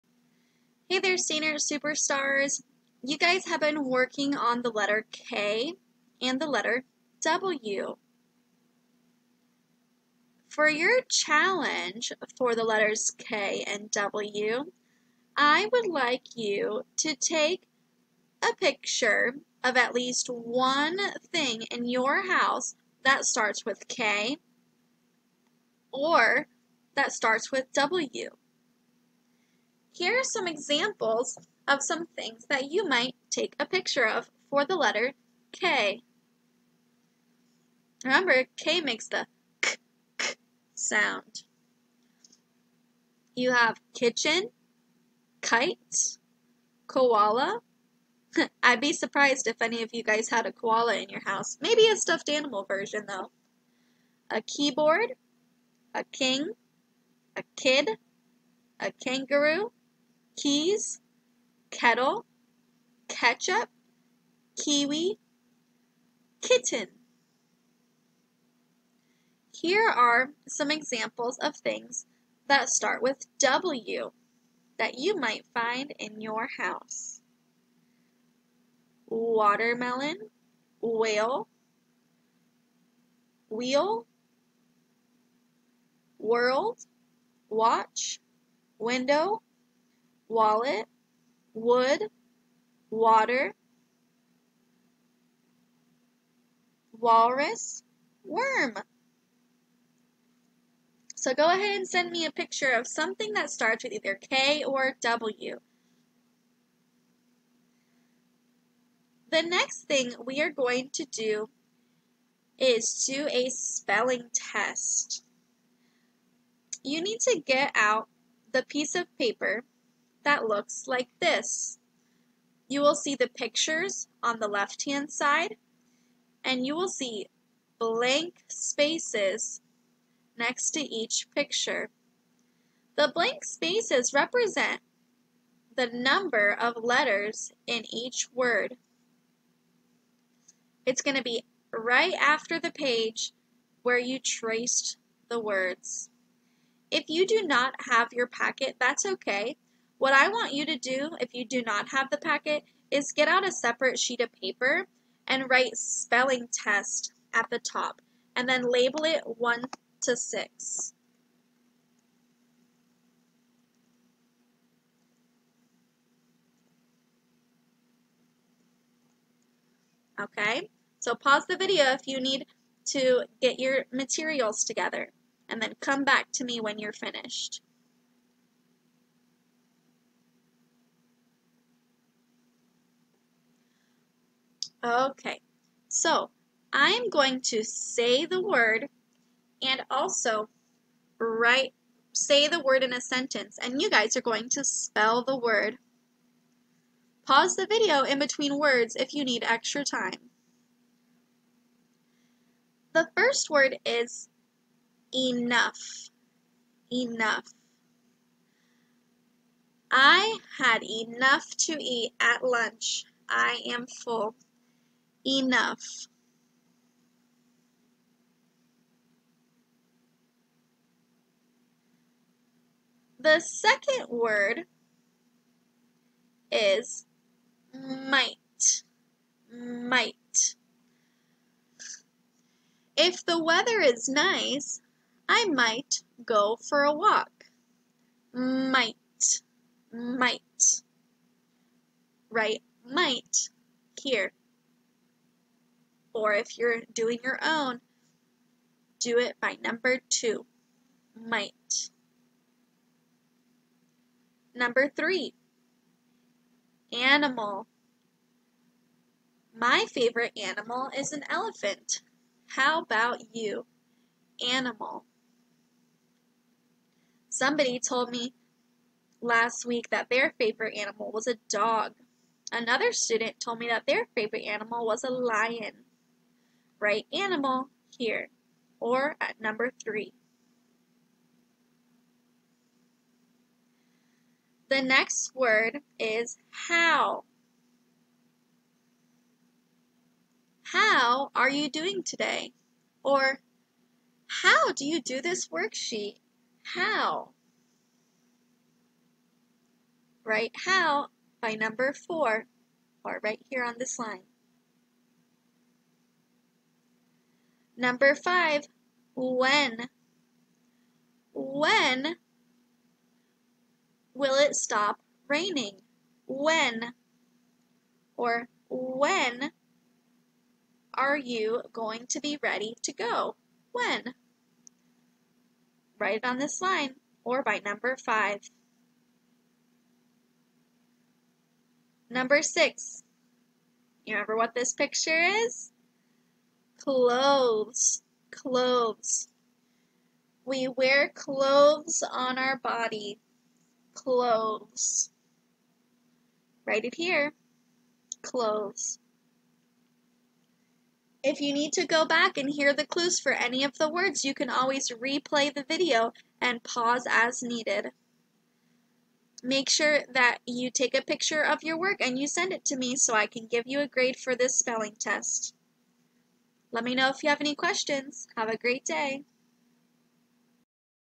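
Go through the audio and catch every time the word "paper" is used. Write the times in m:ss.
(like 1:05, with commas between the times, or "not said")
1:59, 2:34.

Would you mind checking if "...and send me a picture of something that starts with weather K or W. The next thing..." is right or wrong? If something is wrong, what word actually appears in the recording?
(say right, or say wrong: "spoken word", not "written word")
wrong: "either", not "weather".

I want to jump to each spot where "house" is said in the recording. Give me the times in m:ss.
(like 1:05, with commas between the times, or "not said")
0:22, 0:51, 1:16.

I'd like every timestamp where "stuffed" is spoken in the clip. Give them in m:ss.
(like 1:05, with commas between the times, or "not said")
0:51.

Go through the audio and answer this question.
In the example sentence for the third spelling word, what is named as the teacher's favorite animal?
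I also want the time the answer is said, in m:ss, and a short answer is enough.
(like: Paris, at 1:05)
elephant, at 4:21.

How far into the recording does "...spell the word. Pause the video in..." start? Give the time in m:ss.
3:14.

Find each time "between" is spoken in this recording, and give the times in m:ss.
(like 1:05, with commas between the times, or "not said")
3:18.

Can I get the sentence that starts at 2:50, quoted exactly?
Okay, so pause the video if you need to get your materials together and then come back to me when you're finished.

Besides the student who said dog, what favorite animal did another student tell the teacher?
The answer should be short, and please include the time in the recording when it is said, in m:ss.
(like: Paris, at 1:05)
lion, at 4:35.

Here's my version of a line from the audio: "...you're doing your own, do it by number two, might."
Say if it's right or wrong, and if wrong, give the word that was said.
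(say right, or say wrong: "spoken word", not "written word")
right.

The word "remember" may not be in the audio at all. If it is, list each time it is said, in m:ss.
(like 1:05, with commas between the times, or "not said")
0:38, 5:34.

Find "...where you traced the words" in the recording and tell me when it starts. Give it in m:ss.
2:23.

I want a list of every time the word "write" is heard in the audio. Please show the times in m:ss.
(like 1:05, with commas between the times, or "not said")
2:35, 3:11, 4:02, 4:36, 5:00, 5:25, 5:46.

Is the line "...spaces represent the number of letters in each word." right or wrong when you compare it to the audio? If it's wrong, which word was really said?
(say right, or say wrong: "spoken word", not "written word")
right.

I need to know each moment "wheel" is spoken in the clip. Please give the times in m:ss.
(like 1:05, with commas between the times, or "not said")
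1:23.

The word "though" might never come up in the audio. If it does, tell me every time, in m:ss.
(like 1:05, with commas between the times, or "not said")
0:53.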